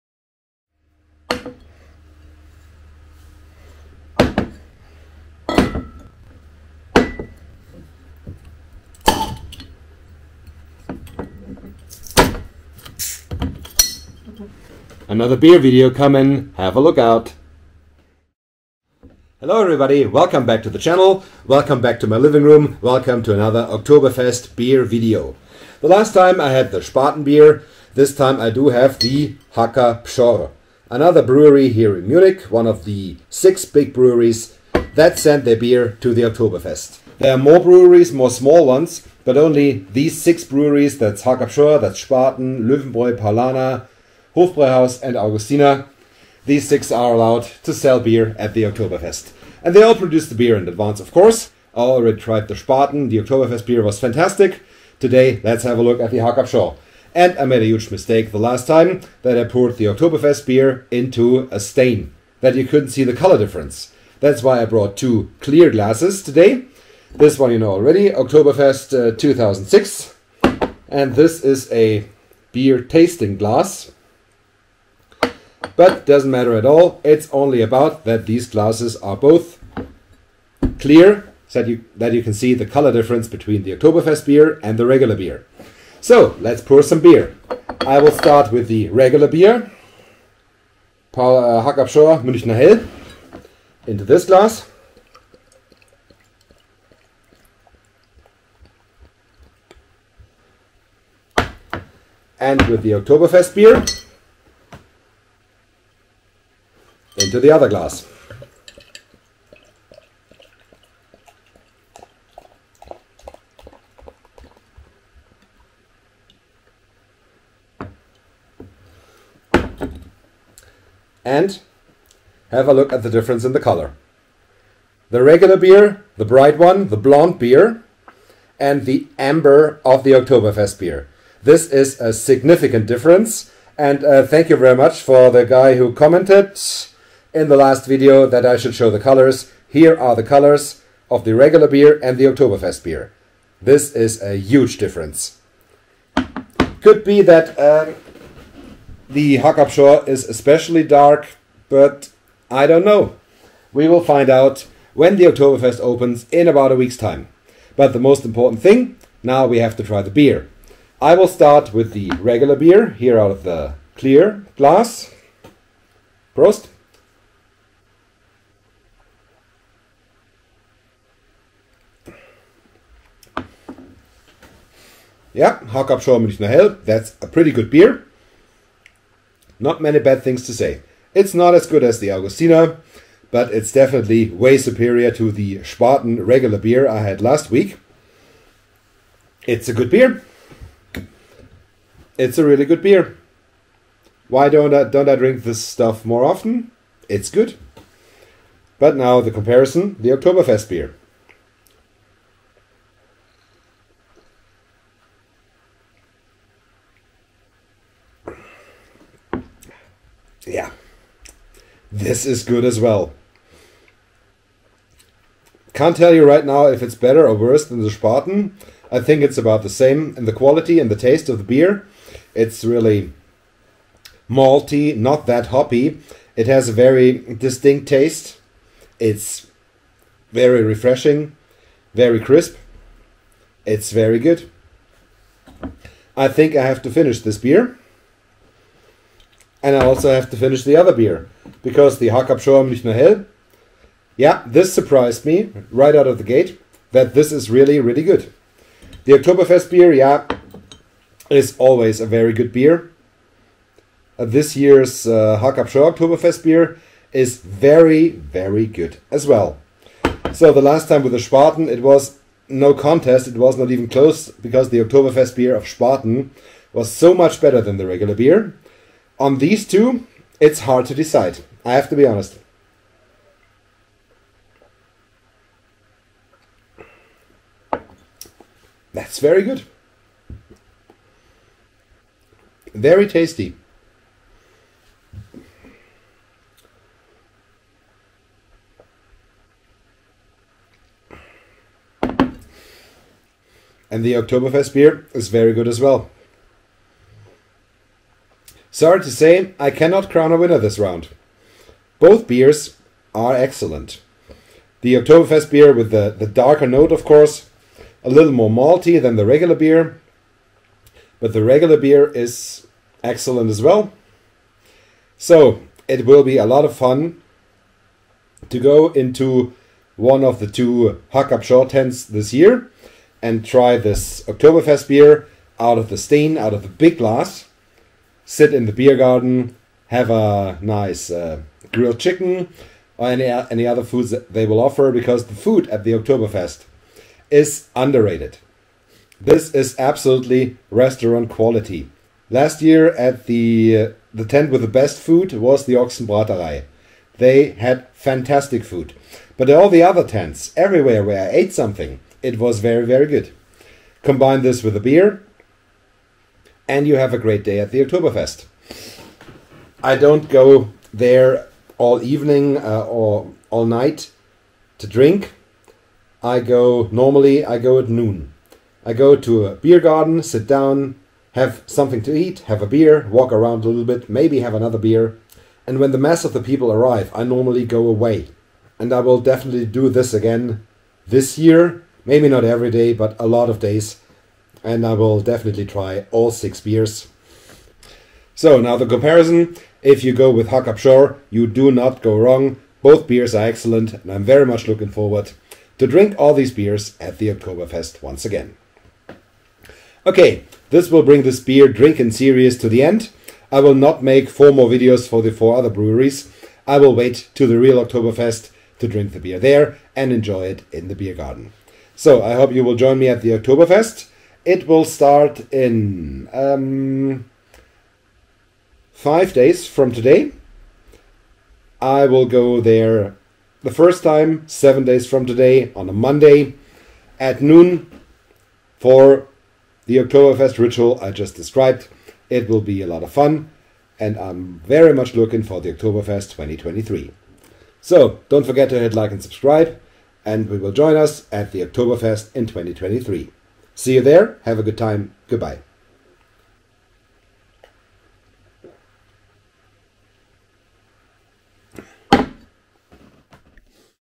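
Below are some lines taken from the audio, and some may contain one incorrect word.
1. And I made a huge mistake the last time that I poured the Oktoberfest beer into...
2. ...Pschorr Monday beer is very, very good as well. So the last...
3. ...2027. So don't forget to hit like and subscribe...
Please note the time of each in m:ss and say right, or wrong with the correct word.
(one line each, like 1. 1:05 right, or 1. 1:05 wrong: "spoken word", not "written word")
1. 0:57 right
2. 4:15 wrong: "Oktoberfest", not "Monday"
3. 7:16 wrong: "2023", not "2027".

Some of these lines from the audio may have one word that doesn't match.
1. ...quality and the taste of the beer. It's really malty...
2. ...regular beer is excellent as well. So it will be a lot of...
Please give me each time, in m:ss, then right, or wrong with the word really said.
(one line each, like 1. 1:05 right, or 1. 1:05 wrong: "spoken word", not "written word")
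1. 3:40 right
2. 5:11 right.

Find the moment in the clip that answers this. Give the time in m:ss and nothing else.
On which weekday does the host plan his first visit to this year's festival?
7:05.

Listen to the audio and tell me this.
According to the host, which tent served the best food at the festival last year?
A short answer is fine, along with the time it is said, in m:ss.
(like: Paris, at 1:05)
Ochsenbraterei, at 5:45.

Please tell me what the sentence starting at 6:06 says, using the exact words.
I go normally, I go at noon.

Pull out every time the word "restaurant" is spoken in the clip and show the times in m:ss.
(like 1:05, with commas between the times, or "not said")
5:40.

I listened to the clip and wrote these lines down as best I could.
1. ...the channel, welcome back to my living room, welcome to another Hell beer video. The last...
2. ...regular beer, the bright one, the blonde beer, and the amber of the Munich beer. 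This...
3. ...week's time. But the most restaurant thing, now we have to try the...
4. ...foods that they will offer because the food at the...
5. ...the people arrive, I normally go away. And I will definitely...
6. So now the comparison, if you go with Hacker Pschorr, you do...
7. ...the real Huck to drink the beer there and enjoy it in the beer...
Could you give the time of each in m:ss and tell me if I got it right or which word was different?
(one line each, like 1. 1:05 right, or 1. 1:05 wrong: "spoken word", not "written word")
1. 0:20 wrong: "Oktoberfest", not "Hell"
2. 2:05 wrong: "Oktoberfest", not "Munich"
3. 2:36 wrong: "important", not "restaurant"
4. 5:33 right
5. 6:16 right
6. 6:28 right
7. 6:47 wrong: "Oktoberfest", not "Huck".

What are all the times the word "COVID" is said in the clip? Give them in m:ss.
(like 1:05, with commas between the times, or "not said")
not said.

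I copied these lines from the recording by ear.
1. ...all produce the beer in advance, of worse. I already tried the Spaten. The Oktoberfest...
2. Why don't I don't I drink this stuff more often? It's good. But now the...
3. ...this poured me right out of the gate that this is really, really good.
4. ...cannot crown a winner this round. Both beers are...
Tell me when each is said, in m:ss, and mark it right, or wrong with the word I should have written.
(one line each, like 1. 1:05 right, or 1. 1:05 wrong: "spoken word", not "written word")
1. 0:49 wrong: "course", not "worse"
2. 3:14 right
3. 4:04 wrong: "surprised", not "poured"
4. 4:59 right.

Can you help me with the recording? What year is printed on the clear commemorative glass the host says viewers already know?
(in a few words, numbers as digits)
2006.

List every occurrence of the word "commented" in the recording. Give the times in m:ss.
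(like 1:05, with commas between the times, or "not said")
2:15.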